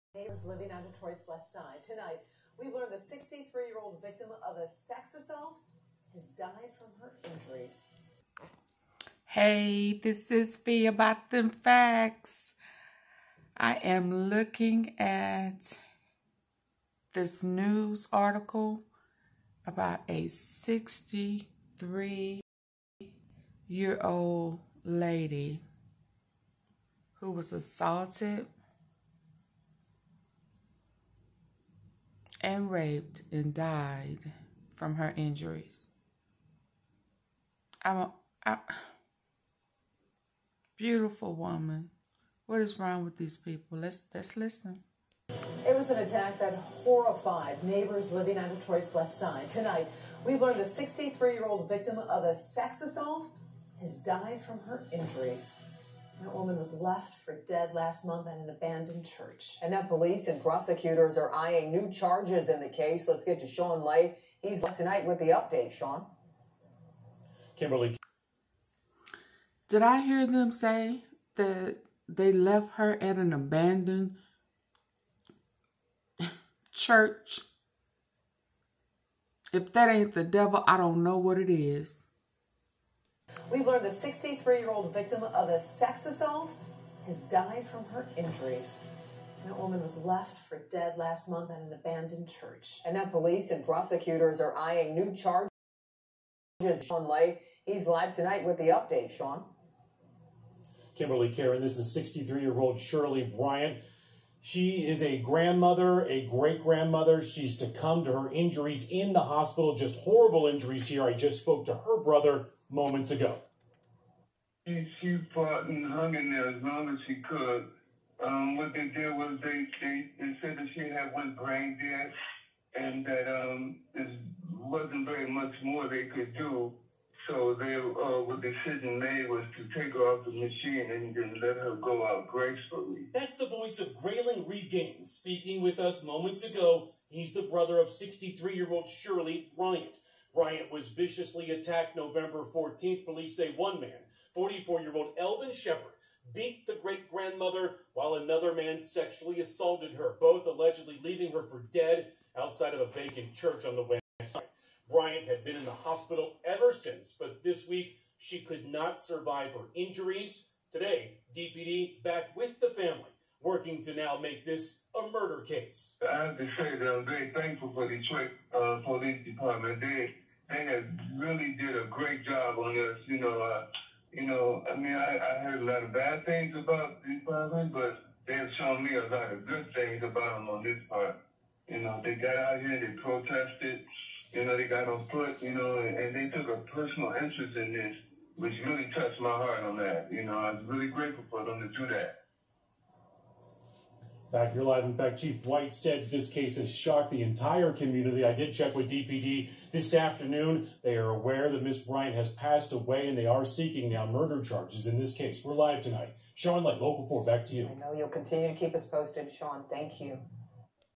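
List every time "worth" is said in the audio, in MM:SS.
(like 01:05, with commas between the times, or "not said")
not said.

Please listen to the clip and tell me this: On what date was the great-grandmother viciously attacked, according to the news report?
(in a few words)
November 14.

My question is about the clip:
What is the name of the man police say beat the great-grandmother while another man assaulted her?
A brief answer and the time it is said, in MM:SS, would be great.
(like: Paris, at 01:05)
Elvin Shepard, at 02:25.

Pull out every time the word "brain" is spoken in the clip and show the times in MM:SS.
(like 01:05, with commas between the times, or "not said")
02:01.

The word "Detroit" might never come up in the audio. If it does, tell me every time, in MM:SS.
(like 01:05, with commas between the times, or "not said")
00:00, 00:48, 02:47.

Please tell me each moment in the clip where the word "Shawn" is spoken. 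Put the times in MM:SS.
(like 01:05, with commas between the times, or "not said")
01:03, 01:36.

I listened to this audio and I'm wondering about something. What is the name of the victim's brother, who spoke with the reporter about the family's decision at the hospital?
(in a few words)
Grayling Reed Gaines.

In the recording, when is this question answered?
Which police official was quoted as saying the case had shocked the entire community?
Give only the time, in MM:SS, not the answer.
03:15.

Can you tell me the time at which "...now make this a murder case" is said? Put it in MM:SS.
02:43.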